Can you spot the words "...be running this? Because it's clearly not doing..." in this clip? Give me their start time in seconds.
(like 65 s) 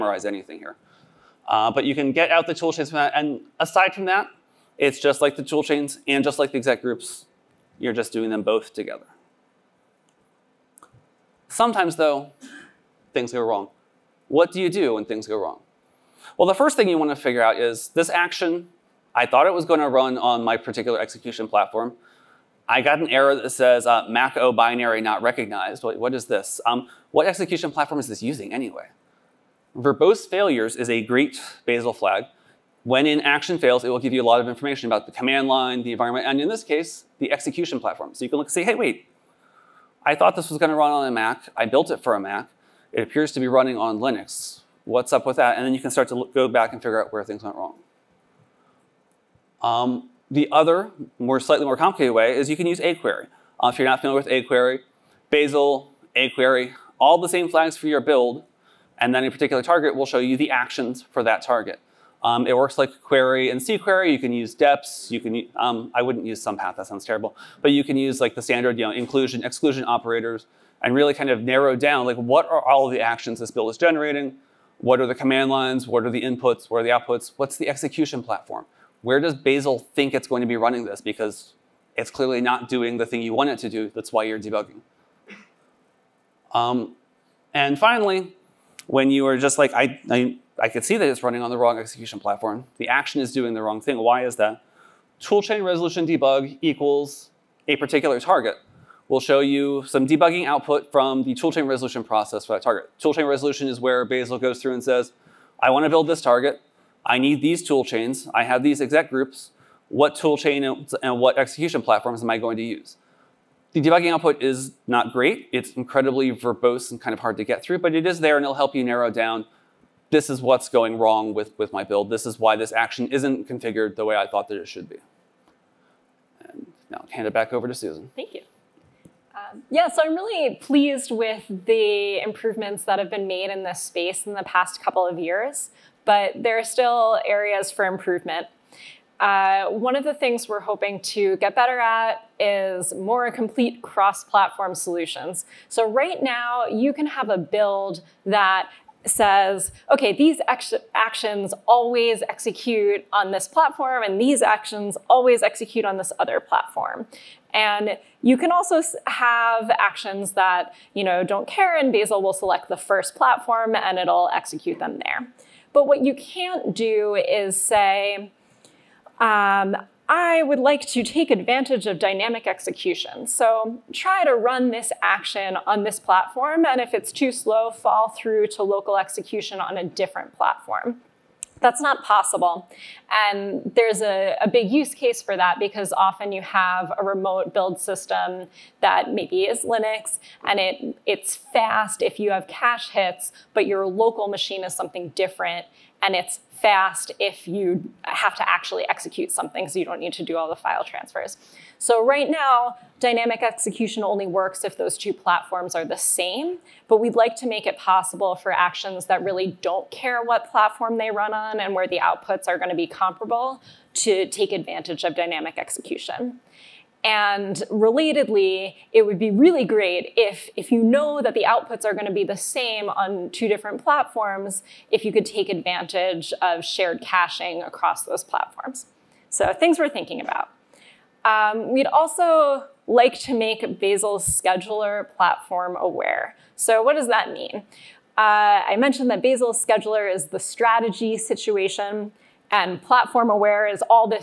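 80 s.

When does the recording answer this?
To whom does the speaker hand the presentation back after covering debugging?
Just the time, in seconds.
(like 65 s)
127 s.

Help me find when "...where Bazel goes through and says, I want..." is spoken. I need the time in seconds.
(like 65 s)
103 s.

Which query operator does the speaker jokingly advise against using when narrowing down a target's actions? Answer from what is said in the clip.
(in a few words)
somepath.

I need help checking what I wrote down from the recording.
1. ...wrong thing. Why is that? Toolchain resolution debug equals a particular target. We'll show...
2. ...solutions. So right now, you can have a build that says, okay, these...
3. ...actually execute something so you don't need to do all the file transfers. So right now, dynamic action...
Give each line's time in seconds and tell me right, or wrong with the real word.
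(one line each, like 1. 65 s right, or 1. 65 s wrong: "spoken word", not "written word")
1. 93 s right
2. 144 s right
3. 198 s wrong: "execution", not "action".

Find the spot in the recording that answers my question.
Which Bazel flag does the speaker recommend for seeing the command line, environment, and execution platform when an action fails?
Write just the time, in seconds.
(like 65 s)
29 s.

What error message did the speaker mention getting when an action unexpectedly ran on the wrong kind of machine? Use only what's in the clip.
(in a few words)
Mach-O binary not recognized.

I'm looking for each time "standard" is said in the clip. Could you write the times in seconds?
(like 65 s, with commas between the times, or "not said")
68 s.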